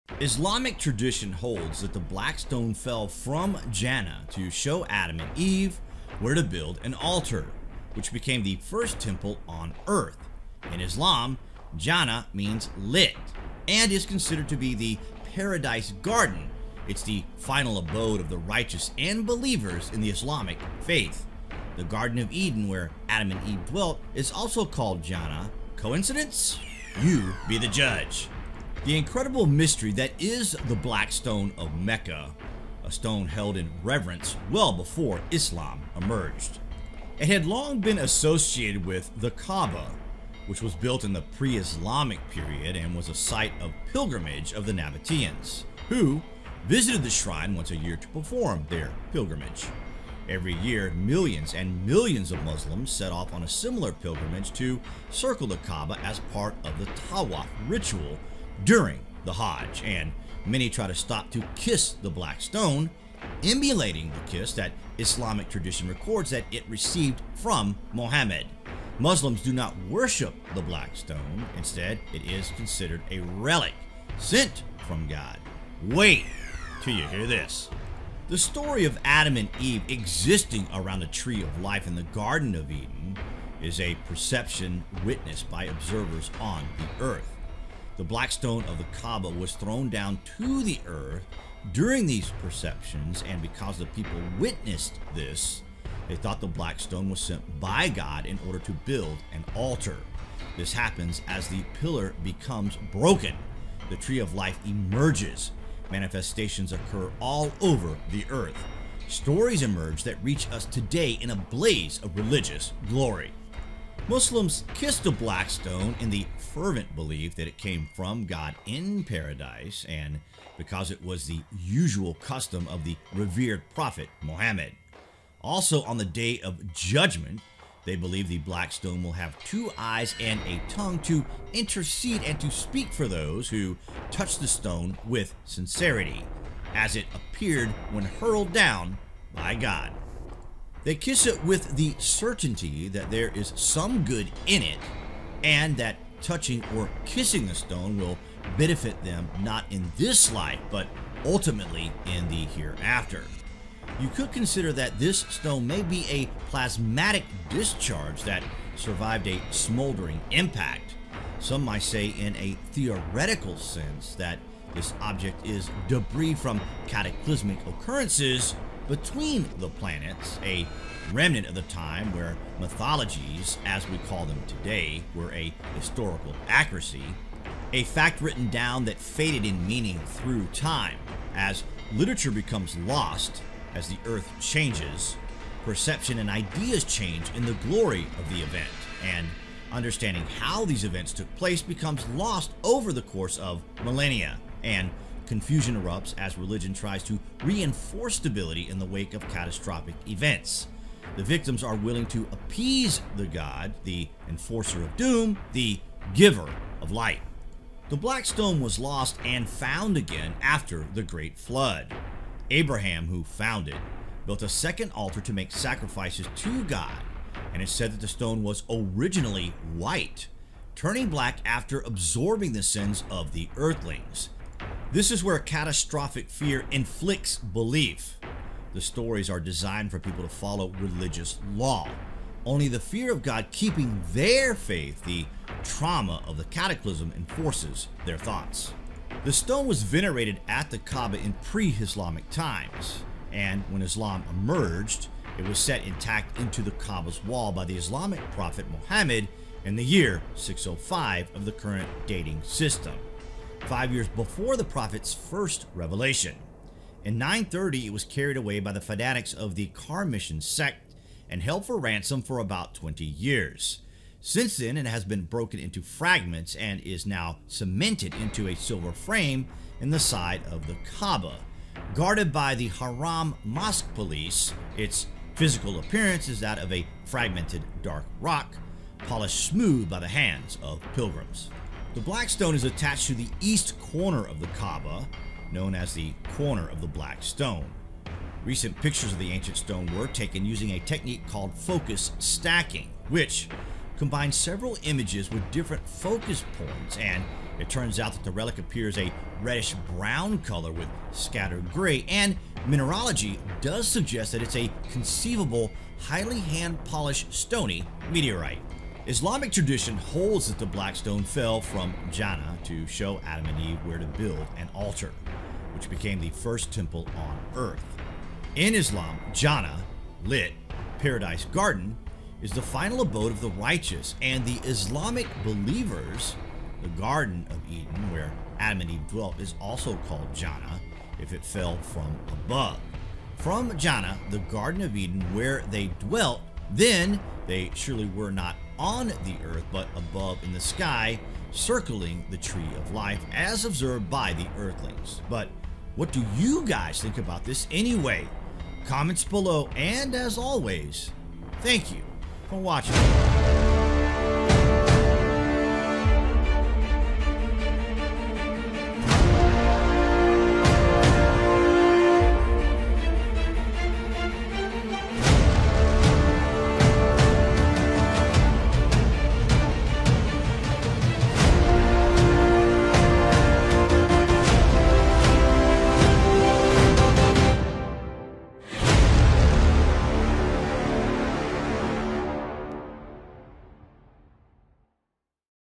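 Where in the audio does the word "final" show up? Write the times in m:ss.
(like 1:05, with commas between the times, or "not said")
0:17, 5:22.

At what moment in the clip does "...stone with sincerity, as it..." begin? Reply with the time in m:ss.
2:14.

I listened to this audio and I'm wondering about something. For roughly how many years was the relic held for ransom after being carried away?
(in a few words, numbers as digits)
about 20 years.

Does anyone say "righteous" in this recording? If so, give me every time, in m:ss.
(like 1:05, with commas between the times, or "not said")
0:18, 5:23.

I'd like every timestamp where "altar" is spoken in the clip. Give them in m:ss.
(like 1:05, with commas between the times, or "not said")
0:06, 1:39, 3:34, 5:14.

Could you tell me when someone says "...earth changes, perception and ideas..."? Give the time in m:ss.
3:04.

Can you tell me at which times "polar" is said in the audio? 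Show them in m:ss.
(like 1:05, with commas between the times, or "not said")
not said.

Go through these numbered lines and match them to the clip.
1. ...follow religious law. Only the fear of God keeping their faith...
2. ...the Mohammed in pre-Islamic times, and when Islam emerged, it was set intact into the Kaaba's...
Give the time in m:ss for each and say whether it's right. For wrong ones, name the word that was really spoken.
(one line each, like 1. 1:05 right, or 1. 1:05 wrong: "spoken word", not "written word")
1. 3:50 right
2. 4:00 wrong: "Kaaba", not "Mohammed".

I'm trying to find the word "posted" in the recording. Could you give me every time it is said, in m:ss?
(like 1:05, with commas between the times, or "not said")
not said.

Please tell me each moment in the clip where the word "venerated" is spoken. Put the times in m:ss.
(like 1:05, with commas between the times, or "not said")
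3:59.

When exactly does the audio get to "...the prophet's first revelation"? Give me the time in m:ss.
4:14.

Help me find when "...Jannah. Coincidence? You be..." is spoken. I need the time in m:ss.
0:25.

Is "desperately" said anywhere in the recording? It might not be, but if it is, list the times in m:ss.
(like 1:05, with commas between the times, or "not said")
not said.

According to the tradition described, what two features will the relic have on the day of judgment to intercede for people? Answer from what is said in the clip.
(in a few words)
two eyes and a tongue.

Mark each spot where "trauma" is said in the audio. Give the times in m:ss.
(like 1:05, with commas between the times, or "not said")
3:55.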